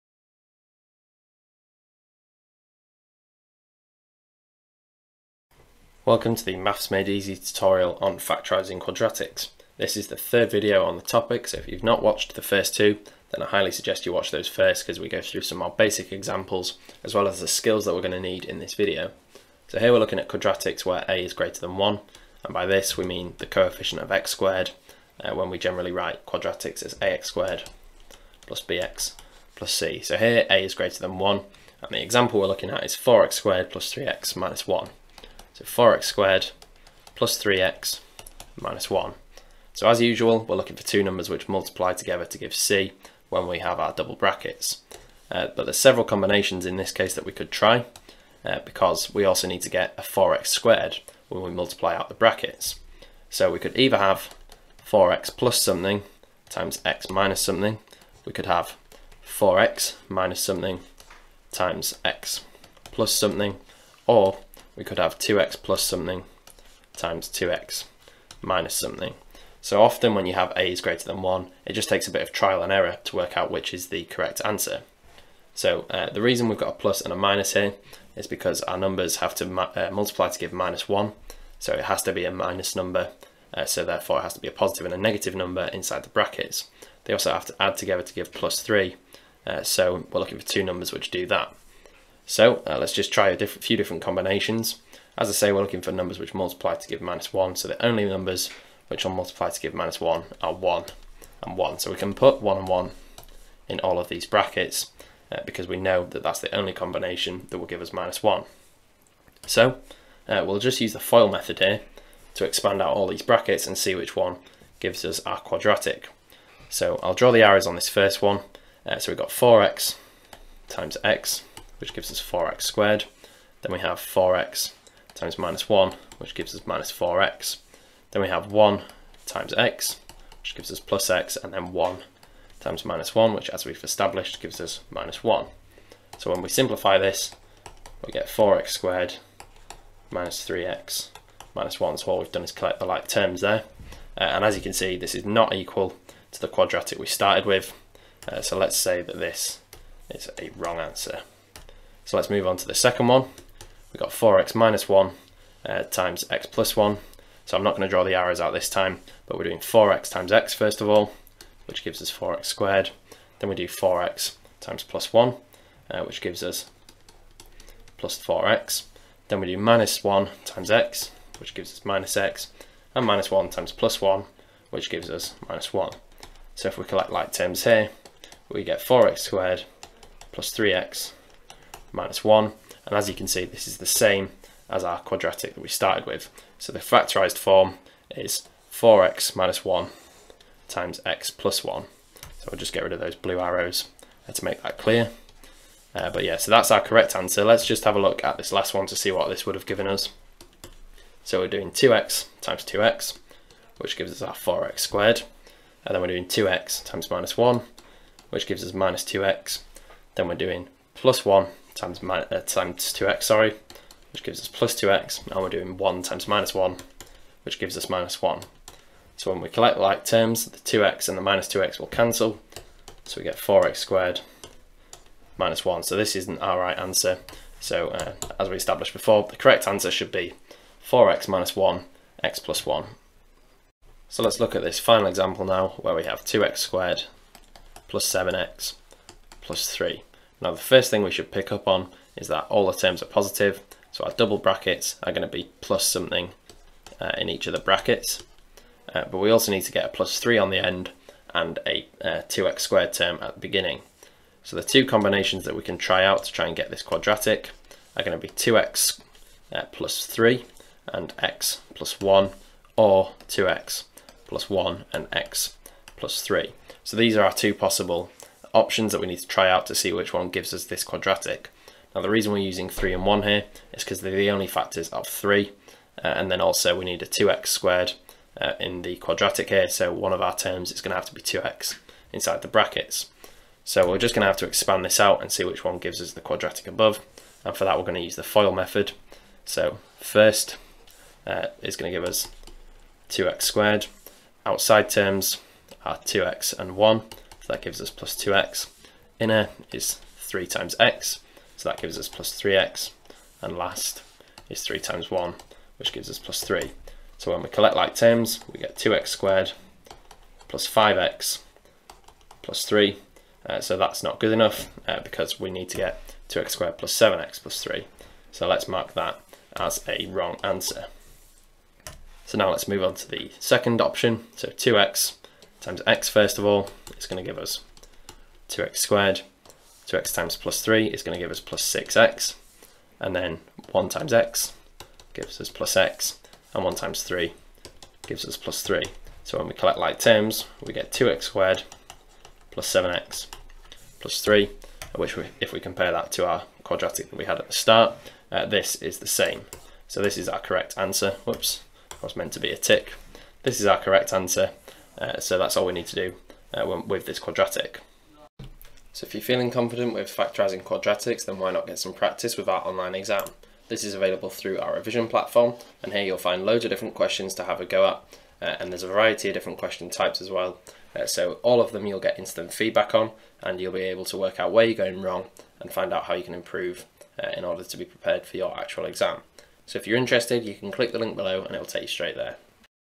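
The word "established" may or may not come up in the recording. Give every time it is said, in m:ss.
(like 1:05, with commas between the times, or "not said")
2:13, 3:48.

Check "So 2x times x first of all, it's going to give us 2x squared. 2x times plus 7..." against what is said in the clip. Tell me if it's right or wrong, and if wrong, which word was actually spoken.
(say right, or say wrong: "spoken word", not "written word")
wrong: "3", not "7".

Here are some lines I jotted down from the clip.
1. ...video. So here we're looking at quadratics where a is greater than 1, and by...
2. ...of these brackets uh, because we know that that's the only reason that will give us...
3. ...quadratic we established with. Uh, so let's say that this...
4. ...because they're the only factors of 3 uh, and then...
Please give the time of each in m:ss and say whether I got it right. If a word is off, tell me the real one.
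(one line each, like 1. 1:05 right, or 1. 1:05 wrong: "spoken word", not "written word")
1. 0:18 right
2. 1:43 wrong: "combination", not "reason"
3. 2:26 wrong: "started", not "established"
4. 4:33 right.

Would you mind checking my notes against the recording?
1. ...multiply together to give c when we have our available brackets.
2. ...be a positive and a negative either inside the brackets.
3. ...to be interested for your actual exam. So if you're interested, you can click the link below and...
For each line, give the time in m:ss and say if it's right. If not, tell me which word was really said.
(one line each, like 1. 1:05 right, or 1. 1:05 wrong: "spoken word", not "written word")
1. 0:41 wrong: "double", not "available"
2. 1:24 wrong: "number", not "either"
3. 6:17 wrong: "prepared", not "interested".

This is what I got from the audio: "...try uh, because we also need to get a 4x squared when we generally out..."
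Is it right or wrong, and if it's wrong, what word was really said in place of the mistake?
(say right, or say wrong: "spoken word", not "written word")
wrong: "multiply", not "generally".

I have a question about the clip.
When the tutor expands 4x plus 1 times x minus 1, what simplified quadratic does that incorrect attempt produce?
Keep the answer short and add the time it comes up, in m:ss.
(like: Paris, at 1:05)
4x squared minus 3x minus 1, at 2:18.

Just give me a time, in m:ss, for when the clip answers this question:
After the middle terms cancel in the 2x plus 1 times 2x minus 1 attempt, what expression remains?
3:43.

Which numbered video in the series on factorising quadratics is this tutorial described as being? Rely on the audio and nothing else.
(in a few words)
third.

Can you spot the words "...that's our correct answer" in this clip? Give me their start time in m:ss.
3:16.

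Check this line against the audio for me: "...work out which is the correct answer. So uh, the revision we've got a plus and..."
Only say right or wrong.
wrong.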